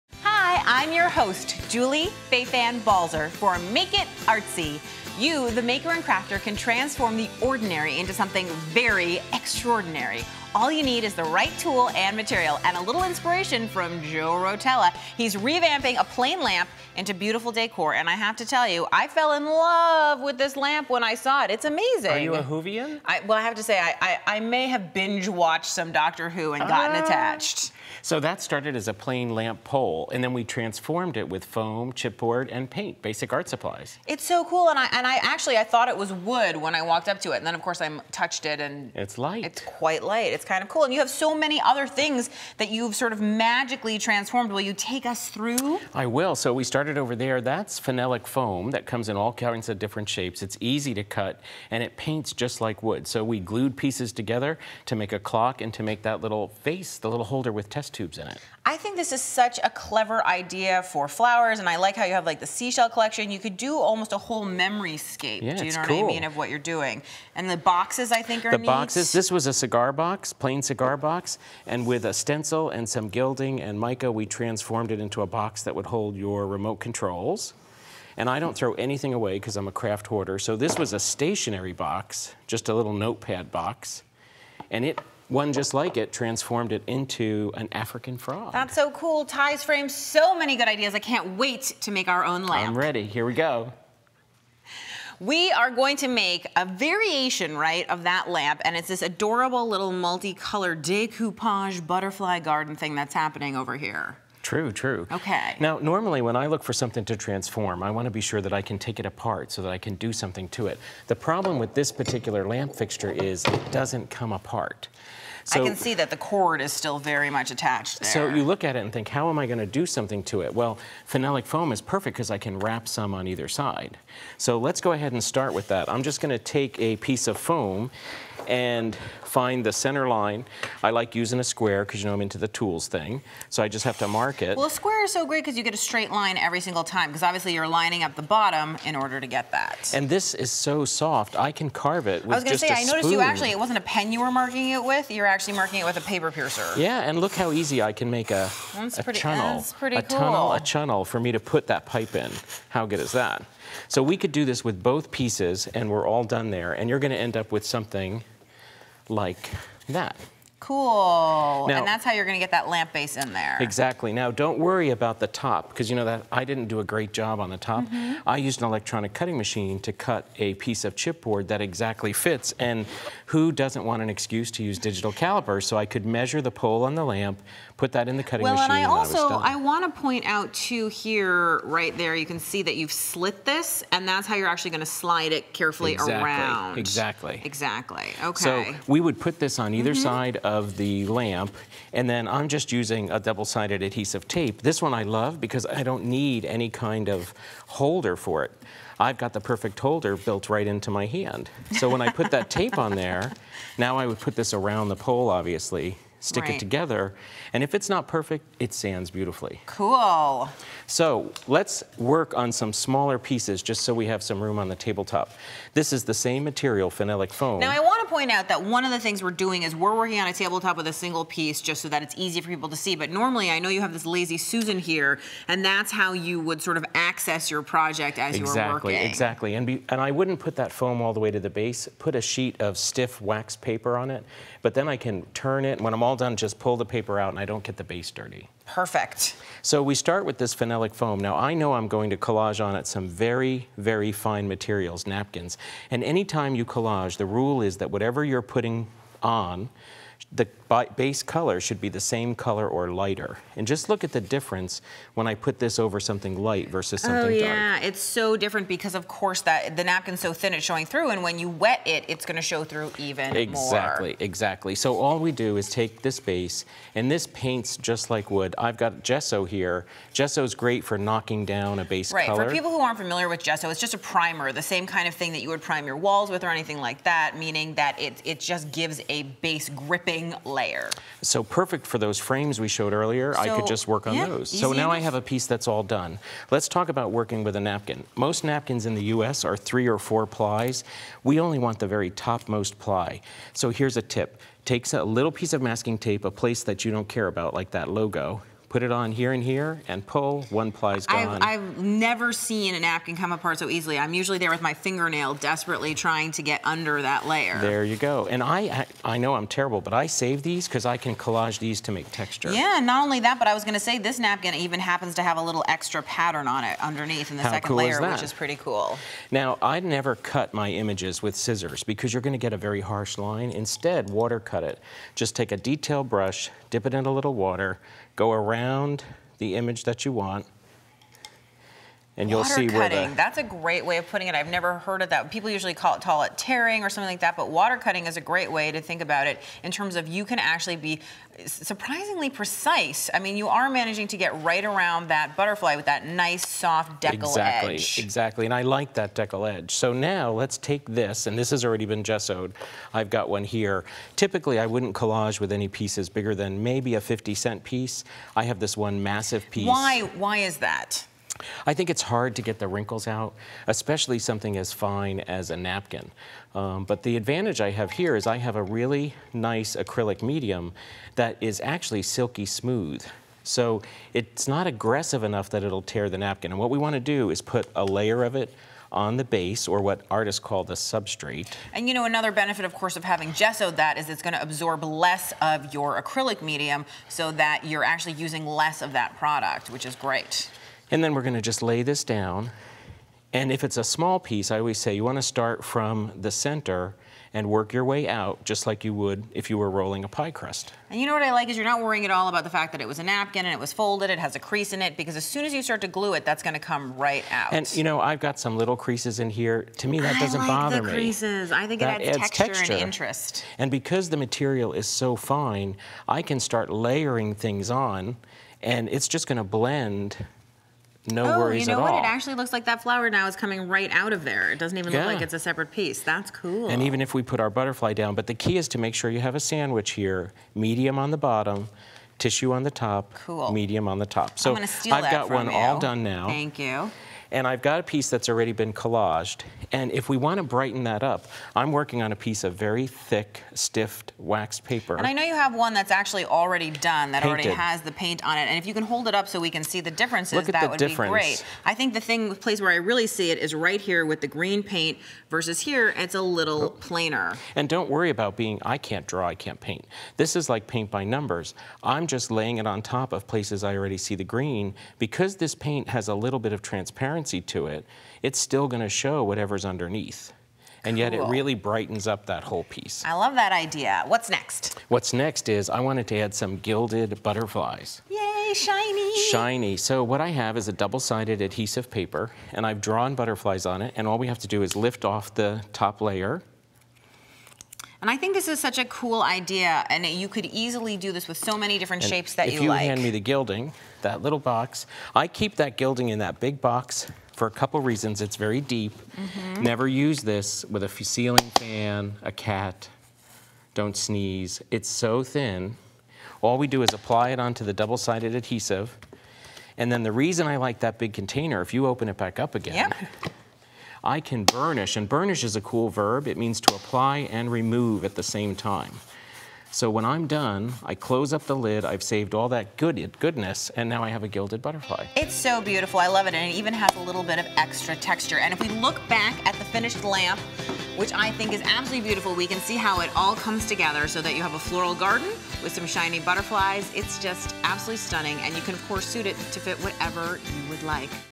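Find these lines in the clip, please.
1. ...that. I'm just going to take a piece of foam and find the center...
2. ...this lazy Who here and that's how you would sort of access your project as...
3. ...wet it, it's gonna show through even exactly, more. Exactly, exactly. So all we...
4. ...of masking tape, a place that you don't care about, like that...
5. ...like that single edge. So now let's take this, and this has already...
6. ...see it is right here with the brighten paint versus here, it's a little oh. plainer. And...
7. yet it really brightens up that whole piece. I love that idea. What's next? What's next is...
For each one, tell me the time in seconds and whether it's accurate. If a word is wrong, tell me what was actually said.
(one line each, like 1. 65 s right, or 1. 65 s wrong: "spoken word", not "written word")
1. 125 s right
2. 223 s wrong: "Susan", not "Who"
3. 261 s right
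4. 295 s right
5. 348 s wrong: "deckle", not "single"
6. 453 s wrong: "green", not "brighten"
7. 470 s right.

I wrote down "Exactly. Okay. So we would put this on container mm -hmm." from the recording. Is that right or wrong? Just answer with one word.
wrong.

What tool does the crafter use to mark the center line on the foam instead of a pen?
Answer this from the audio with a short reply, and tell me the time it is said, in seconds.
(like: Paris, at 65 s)
A paper piercer, at 146 s.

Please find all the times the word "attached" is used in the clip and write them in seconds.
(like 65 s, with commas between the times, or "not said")
27 s, 117 s.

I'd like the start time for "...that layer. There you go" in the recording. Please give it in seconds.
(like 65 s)
307 s.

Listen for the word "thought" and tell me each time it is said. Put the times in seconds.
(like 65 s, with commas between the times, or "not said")
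35 s.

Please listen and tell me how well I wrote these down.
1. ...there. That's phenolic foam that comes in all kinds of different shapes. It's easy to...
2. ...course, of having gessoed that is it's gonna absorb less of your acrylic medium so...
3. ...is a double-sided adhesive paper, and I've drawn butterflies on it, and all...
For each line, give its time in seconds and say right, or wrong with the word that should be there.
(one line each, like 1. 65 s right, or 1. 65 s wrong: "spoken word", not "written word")
1. 47 s right
2. 382 s right
3. 480 s right.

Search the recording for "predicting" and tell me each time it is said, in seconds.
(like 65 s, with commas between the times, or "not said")
not said.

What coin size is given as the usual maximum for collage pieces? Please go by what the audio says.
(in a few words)
A 50 cent piece.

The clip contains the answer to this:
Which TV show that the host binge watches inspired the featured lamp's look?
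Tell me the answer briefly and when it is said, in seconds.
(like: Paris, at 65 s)
Doctor Who, at 25 s.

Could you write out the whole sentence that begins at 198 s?
I've got the perfect holder built right into my hand.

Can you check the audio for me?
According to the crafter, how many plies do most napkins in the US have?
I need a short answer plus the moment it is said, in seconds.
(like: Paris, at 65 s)
3 or 4, at 289 s.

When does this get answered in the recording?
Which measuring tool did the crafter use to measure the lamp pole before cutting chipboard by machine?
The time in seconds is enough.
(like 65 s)
174 s.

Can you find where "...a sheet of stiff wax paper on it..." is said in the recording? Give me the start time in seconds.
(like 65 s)
232 s.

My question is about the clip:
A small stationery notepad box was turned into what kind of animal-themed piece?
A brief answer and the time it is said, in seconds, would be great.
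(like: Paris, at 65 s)
An African frog, at 87 s.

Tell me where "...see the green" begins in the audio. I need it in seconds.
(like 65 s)
463 s.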